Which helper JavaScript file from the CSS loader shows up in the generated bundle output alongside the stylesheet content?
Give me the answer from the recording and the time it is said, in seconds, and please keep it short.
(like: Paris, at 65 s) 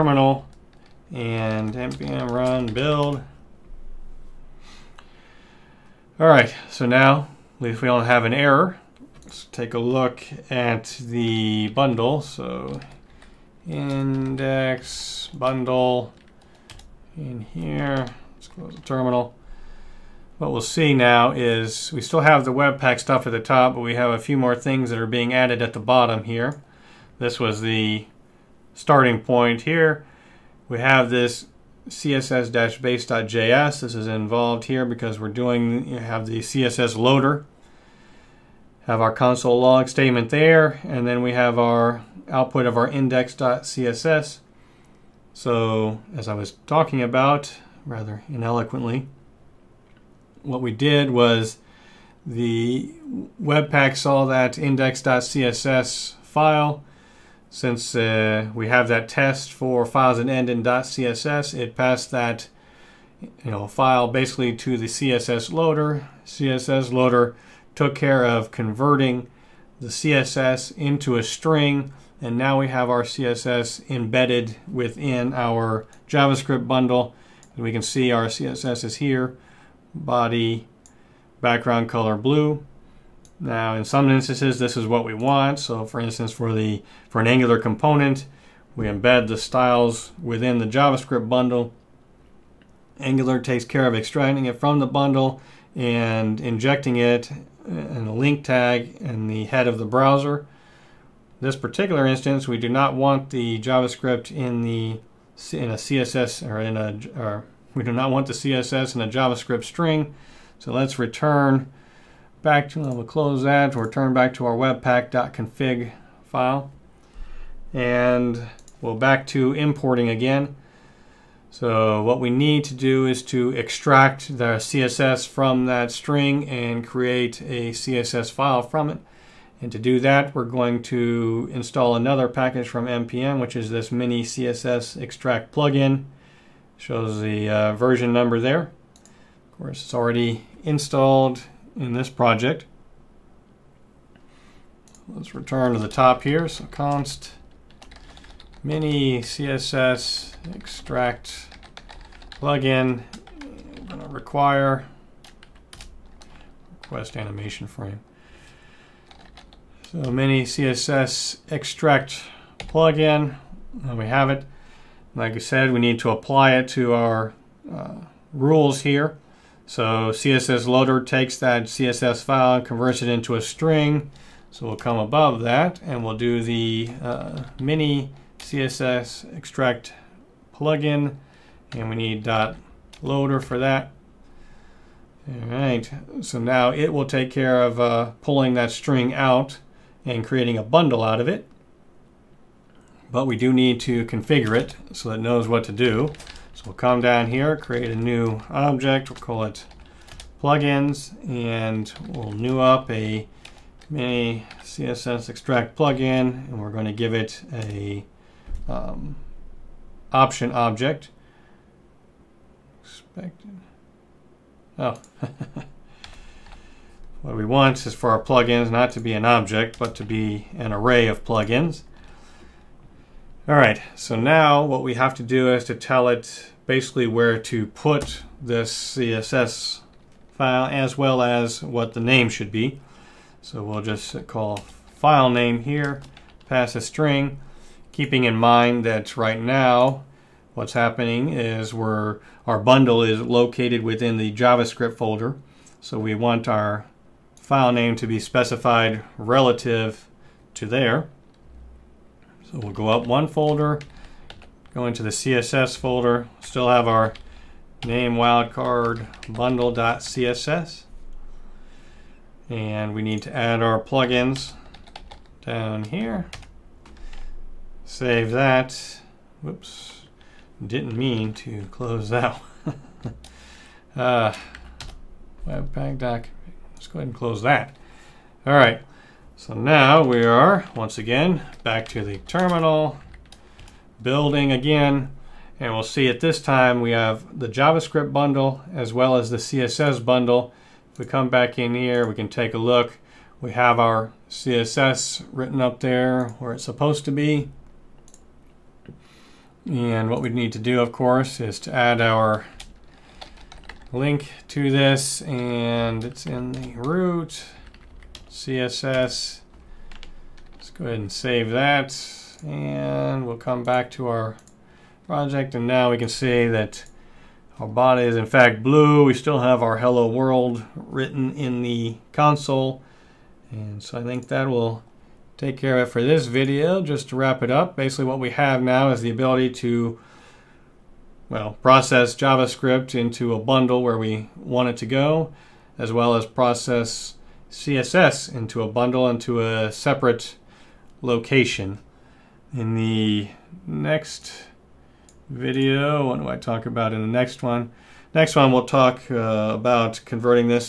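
css-base.js, at 31 s.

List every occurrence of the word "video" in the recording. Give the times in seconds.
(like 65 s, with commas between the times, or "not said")
326 s, 345 s.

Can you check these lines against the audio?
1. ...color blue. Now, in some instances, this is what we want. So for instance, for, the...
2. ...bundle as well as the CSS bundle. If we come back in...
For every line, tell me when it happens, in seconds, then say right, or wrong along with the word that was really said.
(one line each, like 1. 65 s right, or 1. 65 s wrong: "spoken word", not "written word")
1. 81 s right
2. 288 s right.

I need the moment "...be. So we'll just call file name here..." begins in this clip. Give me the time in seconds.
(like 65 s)
232 s.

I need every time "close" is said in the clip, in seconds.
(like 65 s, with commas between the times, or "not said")
18 s, 113 s, 271 s, 277 s.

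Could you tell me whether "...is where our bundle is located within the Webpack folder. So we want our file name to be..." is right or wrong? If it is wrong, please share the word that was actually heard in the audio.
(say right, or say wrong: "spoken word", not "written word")
wrong: "JavaScript", not "Webpack".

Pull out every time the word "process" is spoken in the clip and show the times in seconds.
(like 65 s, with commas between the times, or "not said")
331 s, 336 s.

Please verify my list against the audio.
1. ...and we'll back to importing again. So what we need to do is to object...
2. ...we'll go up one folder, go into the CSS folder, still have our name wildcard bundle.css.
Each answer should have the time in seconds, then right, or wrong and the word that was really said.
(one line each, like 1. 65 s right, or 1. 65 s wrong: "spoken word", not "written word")
1. 117 s wrong: "extract", not "object"
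2. 252 s right.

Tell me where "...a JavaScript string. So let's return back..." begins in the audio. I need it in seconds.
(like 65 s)
109 s.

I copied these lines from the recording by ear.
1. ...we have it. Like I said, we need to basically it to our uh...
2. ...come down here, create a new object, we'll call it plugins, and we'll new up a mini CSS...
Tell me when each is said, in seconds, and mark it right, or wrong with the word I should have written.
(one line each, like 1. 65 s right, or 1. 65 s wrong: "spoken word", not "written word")
1. 163 s wrong: "apply", not "basically"
2. 196 s right.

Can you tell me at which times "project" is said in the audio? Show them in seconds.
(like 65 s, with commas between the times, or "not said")
142 s, 315 s.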